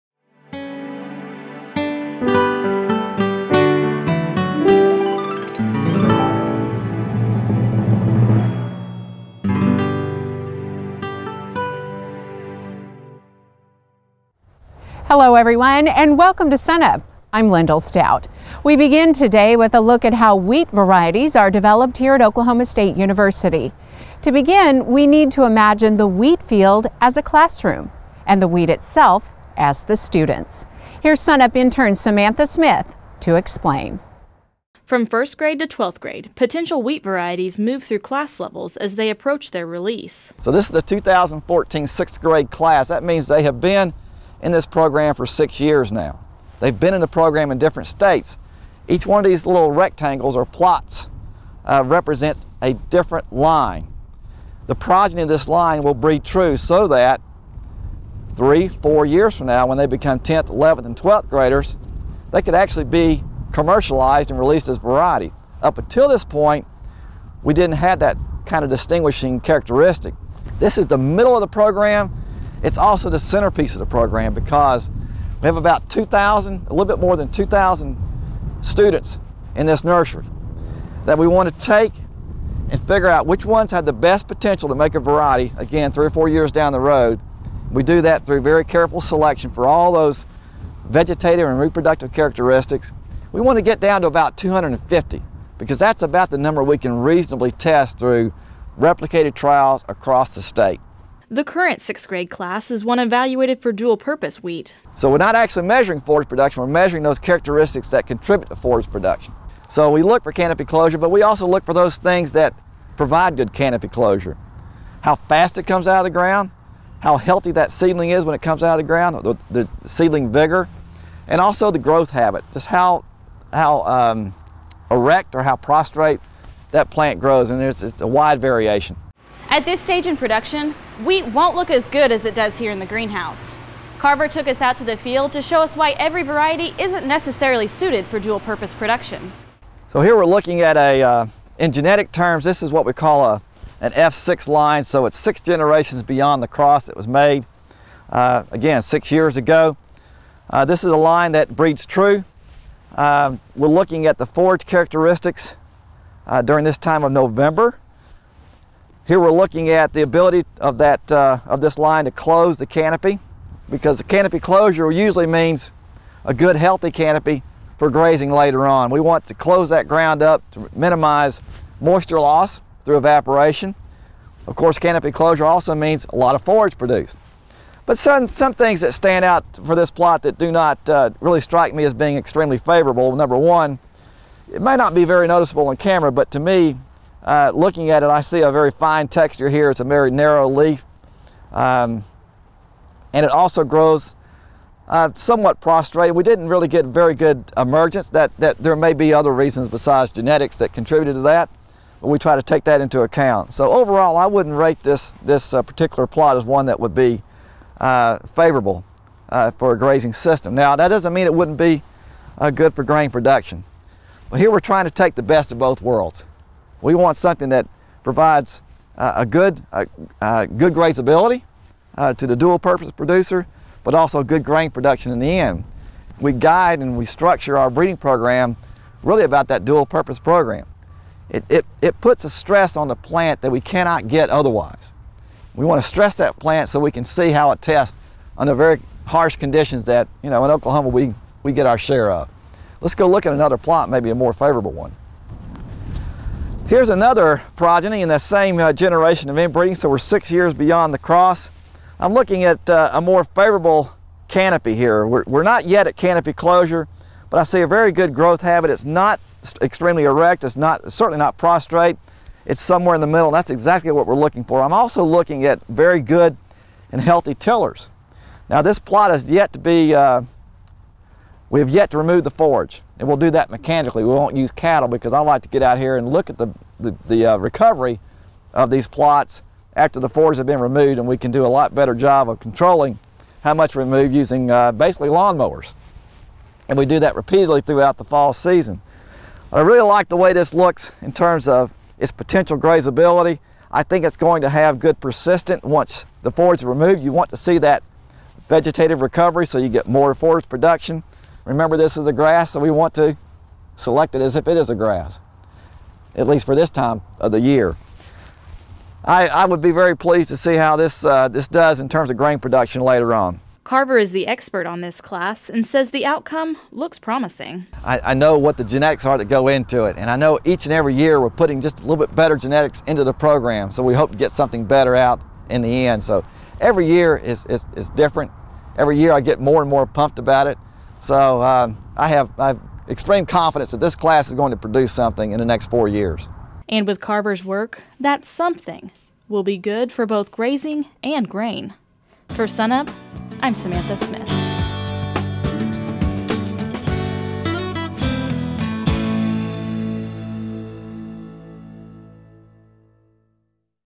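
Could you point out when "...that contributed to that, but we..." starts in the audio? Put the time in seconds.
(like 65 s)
200 s.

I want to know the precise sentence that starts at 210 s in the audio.
Now, that doesn't mean it wouldn't be good for grain production.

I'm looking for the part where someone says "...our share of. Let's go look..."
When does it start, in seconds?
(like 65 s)
241 s.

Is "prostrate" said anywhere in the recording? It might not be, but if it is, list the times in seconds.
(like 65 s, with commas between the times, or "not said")
125 s, 195 s, 261 s.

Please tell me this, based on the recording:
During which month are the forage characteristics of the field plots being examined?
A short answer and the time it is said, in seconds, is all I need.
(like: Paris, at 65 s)
November, at 157 s.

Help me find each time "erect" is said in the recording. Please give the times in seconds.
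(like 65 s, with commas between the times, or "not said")
124 s, 260 s.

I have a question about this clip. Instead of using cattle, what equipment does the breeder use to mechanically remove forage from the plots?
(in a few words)
Lawnmowers.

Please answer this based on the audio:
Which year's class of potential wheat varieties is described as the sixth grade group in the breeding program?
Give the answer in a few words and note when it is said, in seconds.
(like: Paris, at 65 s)
2014, at 40 s.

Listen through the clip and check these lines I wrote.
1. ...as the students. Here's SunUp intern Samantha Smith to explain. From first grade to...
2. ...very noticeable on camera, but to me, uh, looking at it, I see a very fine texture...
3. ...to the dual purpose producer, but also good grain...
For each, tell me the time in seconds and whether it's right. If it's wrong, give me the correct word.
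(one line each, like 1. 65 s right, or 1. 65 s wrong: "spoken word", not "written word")
1. 29 s right
2. 185 s right
3. 222 s right.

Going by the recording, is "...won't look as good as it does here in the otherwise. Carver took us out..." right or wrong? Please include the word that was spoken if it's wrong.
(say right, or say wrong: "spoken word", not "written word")
wrong: "greenhouse", not "otherwise".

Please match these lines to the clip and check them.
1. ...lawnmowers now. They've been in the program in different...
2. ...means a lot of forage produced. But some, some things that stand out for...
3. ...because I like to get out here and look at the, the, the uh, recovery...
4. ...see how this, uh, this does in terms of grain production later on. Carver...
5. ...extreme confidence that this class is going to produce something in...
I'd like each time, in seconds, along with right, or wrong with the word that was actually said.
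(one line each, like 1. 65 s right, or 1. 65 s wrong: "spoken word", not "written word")
1. 45 s wrong: "years", not "lawnmowers"
2. 175 s right
3. 274 s right
4. 310 s right
5. 332 s right.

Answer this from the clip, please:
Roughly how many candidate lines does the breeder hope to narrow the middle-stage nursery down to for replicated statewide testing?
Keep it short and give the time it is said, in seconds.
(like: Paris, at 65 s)
250, at 94 s.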